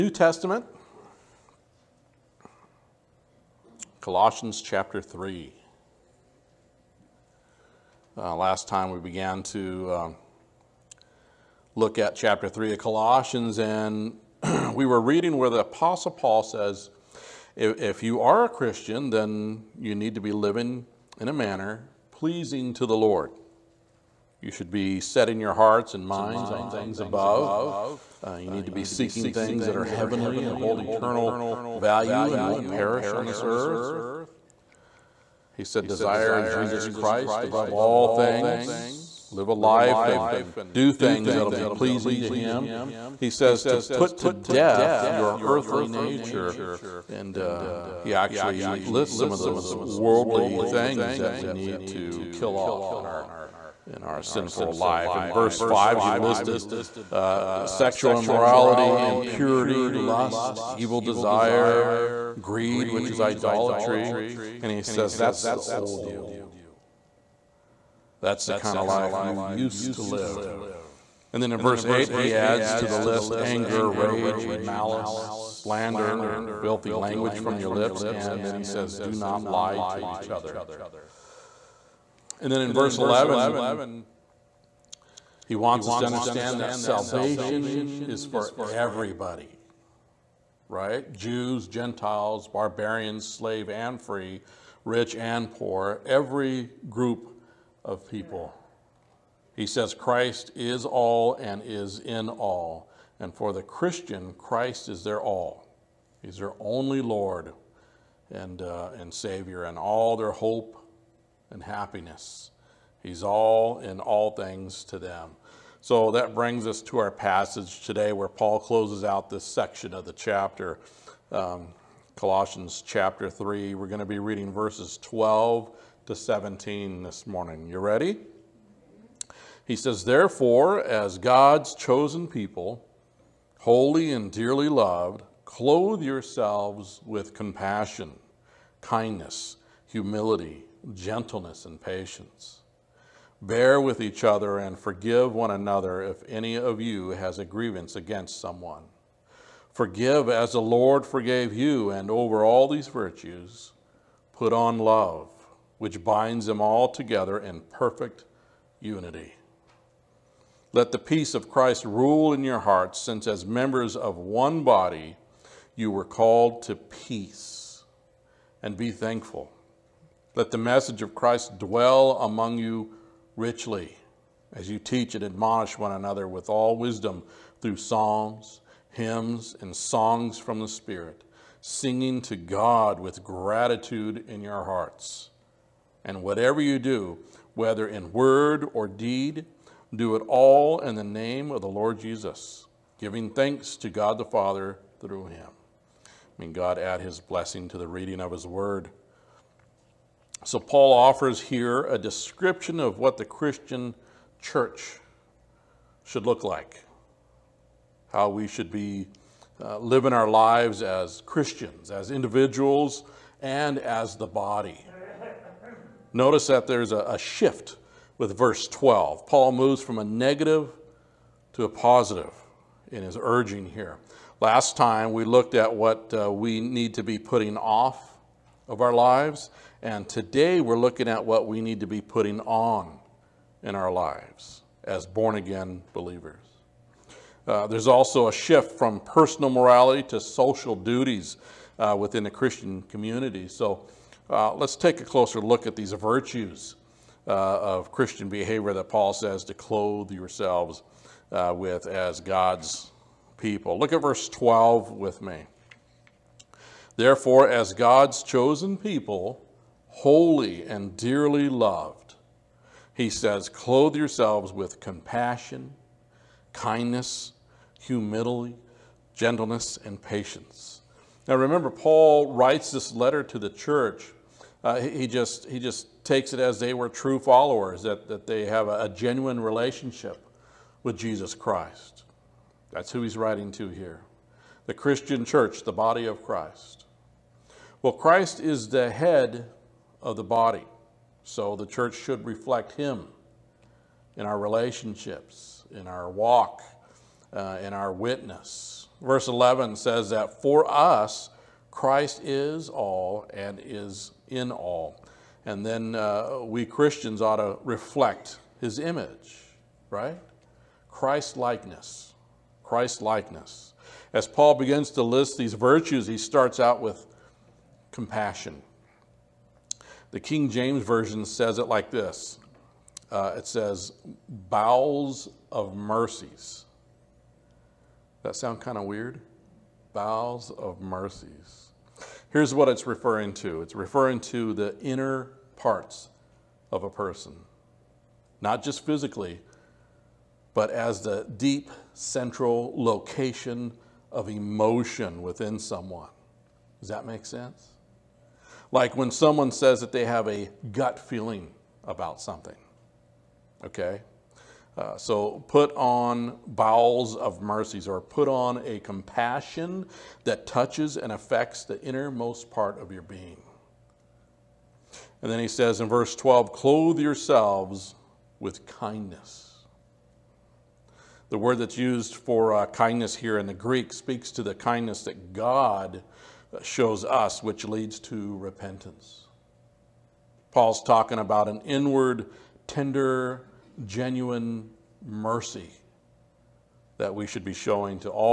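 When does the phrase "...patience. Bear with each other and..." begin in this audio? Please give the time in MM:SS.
02:21.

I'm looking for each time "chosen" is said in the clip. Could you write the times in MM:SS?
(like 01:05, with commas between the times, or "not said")
02:11, 04:18.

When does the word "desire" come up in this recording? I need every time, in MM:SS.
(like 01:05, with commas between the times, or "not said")
00:35, 01:01.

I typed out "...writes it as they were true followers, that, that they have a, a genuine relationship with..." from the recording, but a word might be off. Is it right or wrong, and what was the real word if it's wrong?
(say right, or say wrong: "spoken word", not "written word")
wrong: "takes", not "writes".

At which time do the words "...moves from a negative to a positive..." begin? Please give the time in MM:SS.
03:39.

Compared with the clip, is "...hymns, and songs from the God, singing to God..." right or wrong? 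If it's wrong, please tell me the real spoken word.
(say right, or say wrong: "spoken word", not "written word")
wrong: "Spirit", not "God".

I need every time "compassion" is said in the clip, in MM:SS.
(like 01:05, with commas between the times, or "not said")
02:17, 04:24, 05:17, 05:58.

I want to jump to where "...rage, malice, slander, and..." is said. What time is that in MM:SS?
01:13.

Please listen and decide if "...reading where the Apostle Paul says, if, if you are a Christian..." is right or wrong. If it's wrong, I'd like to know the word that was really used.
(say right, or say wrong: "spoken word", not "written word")
right.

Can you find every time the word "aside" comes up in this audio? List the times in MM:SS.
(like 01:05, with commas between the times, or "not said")
not said.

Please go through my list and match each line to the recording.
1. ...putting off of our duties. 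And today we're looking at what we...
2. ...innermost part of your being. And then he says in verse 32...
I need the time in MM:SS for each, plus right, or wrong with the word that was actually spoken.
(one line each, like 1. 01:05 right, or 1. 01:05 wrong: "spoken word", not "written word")
1. 03:47 wrong: "lives", not "duties"
2. 06:01 wrong: "12", not "32".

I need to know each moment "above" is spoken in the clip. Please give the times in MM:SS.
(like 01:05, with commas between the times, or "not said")
00:27, 00:37.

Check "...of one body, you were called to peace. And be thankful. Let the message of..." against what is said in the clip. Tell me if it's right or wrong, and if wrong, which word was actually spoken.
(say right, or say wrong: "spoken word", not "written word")
right.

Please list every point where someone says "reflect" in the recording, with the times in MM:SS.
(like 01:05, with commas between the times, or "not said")
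04:52, 05:07.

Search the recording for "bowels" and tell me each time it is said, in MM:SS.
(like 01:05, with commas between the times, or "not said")
05:24, 05:29, 05:56.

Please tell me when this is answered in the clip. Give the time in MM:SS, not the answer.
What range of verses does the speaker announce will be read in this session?
02:04.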